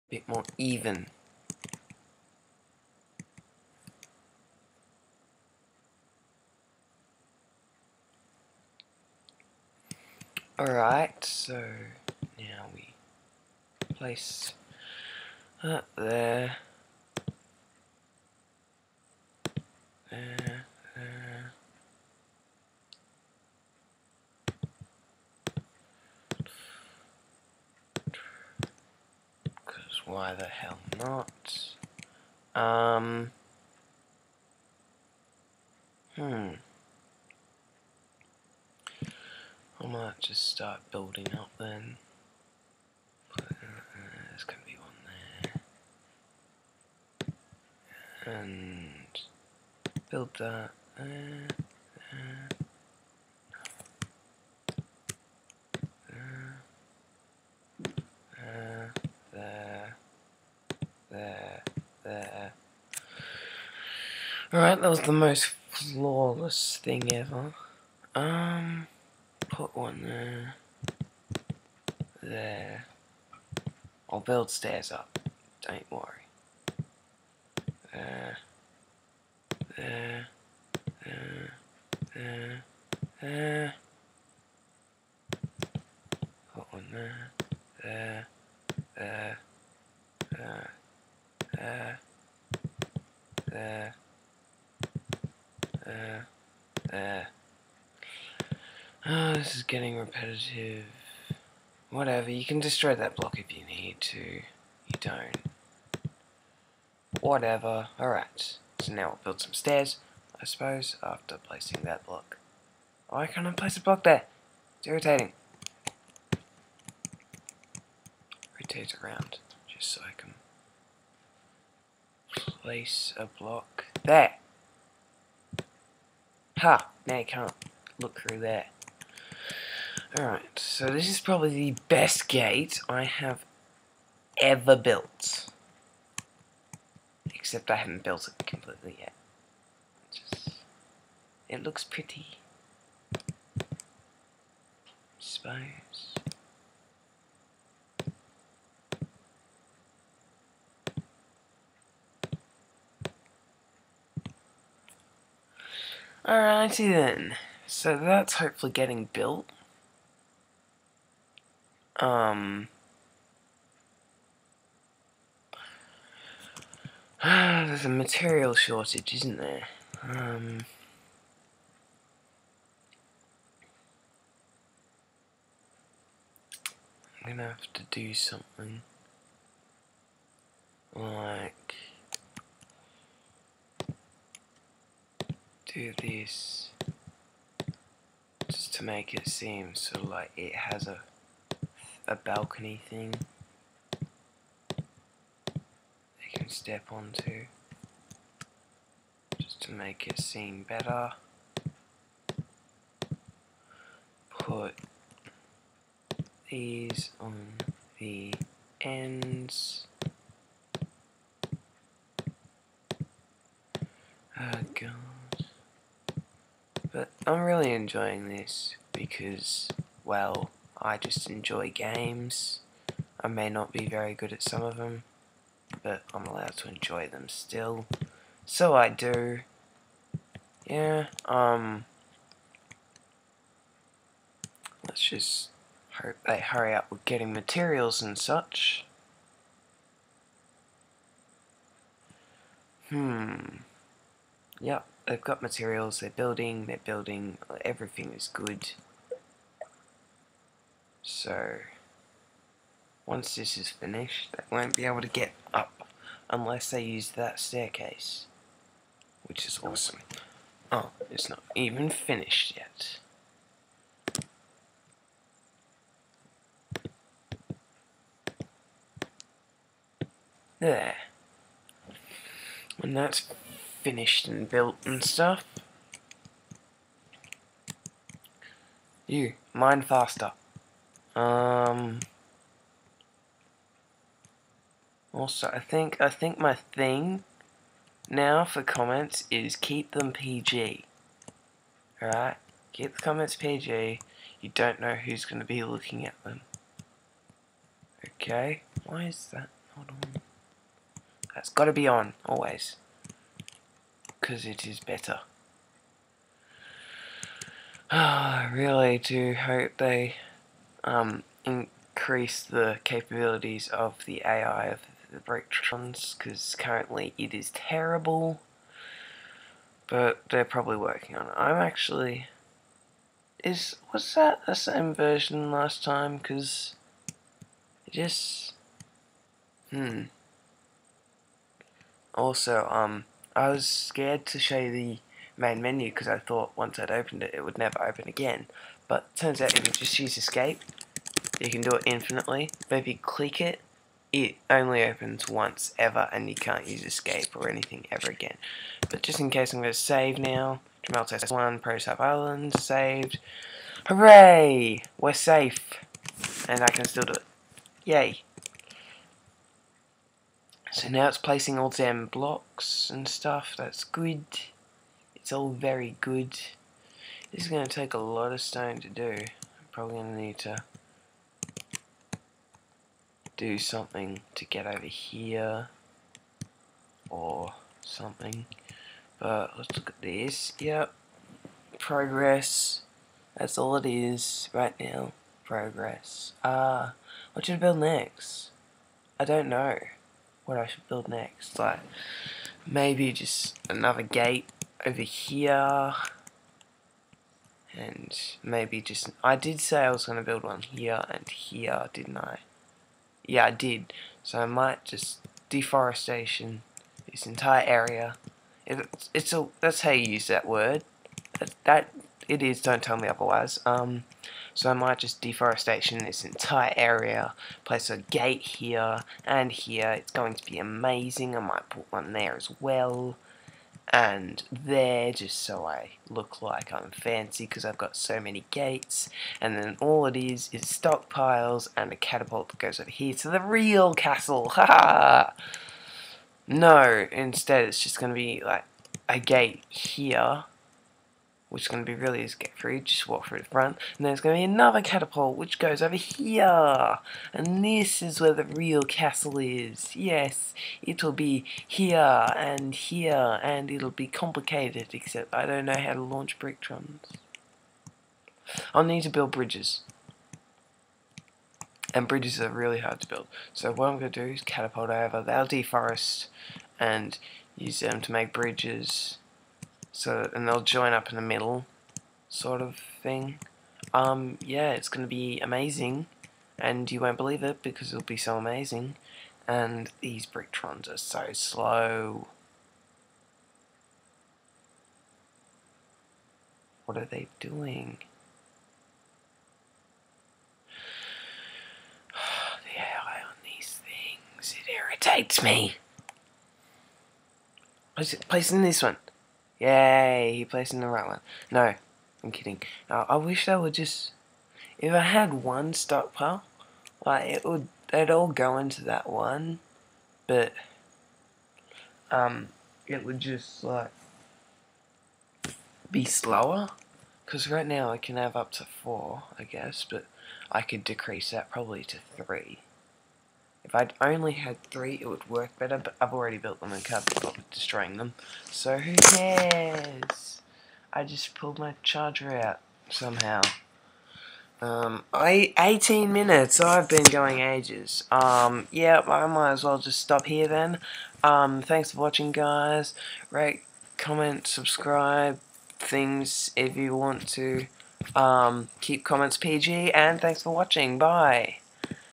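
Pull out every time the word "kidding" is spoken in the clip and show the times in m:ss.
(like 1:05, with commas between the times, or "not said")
8:22.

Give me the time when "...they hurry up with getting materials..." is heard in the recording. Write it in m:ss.
3:56.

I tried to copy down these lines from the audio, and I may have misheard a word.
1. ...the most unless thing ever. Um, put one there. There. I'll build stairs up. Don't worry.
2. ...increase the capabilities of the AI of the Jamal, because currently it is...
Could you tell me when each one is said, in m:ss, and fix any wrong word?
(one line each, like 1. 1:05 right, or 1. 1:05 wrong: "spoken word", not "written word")
1. 1:04 wrong: "flawless", not "unless"
2. 5:11 wrong: "Bricktrons", not "Jamal".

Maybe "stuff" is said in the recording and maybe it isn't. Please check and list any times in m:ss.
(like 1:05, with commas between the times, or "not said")
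4:35, 6:03.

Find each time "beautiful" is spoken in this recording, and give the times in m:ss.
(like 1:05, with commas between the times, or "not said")
not said.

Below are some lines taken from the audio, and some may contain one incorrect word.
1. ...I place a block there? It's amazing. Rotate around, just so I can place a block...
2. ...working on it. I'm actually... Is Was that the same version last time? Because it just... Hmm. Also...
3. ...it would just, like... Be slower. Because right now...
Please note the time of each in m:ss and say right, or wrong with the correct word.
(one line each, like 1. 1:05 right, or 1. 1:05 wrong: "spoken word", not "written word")
1. 1:53 wrong: "irritating", not "amazing"
2. 5:20 right
3. 8:32 right.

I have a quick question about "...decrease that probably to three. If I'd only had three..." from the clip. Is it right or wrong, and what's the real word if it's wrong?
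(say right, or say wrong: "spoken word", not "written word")
right.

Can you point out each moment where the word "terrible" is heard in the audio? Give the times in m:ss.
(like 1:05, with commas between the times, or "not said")
5:17.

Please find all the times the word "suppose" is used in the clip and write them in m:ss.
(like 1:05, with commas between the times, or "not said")
1:50, 2:25.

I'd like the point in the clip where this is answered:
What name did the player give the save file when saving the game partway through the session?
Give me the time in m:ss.
5:50.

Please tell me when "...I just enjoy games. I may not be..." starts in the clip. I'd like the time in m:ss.
3:40.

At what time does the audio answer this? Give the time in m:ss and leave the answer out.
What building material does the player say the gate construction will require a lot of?
6:08.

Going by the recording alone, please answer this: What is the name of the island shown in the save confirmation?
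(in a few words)
ProSap Island.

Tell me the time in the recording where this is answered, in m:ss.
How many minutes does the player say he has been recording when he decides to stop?
8:55.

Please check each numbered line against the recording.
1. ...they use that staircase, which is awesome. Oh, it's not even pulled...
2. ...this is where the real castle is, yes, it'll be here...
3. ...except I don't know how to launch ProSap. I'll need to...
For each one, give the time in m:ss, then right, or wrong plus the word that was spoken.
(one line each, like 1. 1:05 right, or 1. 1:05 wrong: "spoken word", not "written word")
1. 4:16 wrong: "finished", not "pulled"
2. 7:27 right
3. 7:34 wrong: "Bricktrons", not "ProSap".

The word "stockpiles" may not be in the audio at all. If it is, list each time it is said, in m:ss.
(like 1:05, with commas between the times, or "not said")
7:10, 8:25.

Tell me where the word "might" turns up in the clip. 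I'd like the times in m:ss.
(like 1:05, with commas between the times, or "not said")
0:39, 6:44, 6:54, 7:01, 8:59.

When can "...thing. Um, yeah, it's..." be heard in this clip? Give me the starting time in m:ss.
7:53.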